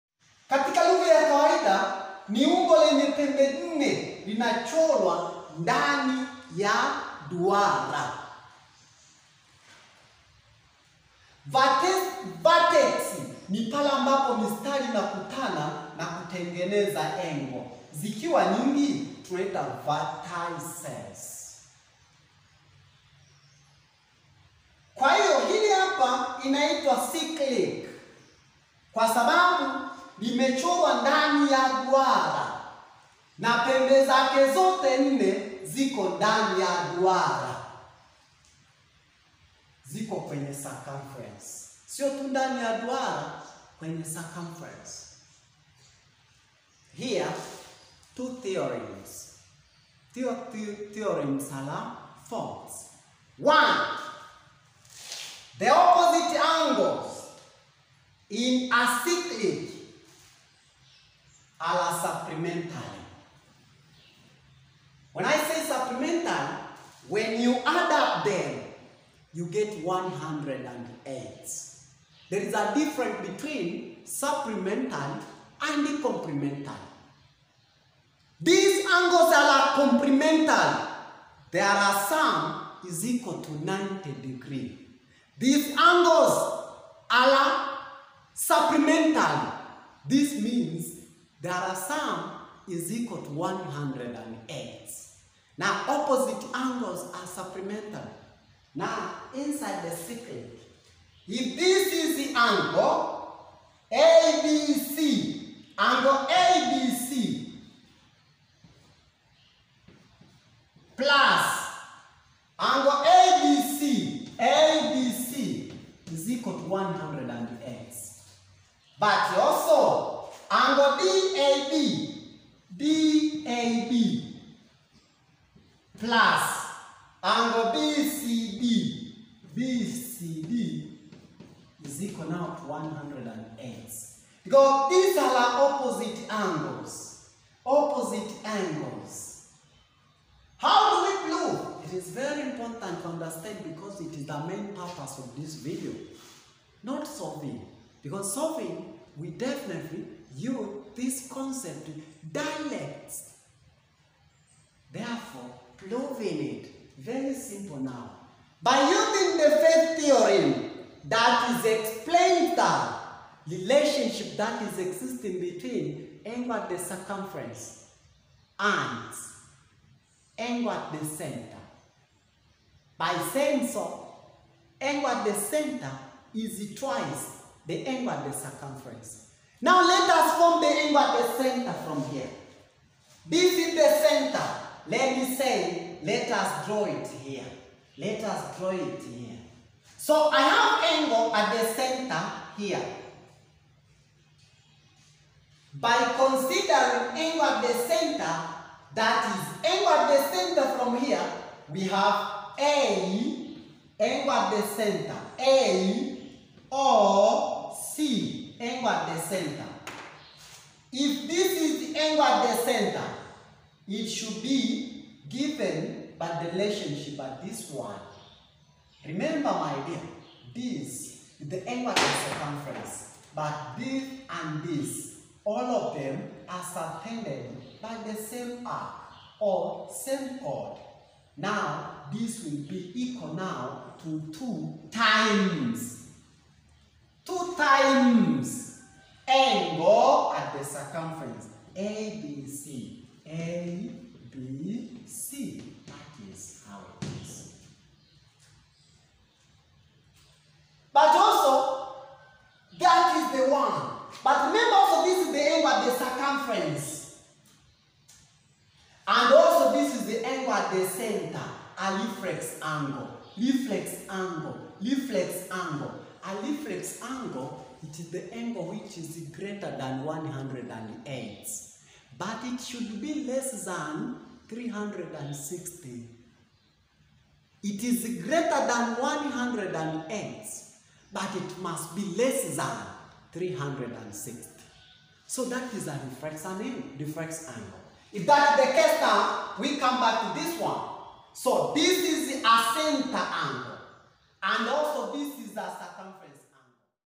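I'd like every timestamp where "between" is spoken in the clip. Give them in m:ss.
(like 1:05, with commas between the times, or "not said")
1:13, 2:45.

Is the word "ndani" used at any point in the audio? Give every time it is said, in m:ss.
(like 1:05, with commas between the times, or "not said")
0:05, 0:31, 0:36, 0:42.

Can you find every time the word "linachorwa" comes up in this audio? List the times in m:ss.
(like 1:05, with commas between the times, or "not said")
0:04.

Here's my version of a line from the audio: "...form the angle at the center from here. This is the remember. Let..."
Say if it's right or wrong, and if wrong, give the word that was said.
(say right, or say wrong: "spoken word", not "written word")
wrong: "center", not "remember".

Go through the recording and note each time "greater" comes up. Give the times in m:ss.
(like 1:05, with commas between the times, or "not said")
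4:29, 4:38.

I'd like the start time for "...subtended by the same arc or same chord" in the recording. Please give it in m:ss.
3:46.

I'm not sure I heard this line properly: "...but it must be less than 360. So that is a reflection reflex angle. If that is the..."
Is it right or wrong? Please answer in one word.
right.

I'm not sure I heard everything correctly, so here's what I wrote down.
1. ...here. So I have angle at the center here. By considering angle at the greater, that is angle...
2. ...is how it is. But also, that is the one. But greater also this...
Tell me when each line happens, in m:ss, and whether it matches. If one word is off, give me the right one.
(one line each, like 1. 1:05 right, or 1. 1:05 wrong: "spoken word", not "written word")
1. 3:09 wrong: "center", not "greater"
2. 4:06 wrong: "remember", not "greater".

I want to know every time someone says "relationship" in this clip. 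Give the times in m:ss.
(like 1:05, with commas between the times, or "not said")
2:43, 3:36.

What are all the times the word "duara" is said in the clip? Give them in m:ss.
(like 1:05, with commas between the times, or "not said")
0:07, 0:31, 0:36, 0:42.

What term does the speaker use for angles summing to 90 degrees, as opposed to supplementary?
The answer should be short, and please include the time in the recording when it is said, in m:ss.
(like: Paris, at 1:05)
complemental, at 1:16.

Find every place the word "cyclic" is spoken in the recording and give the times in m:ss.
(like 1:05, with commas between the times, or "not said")
0:27, 0:59.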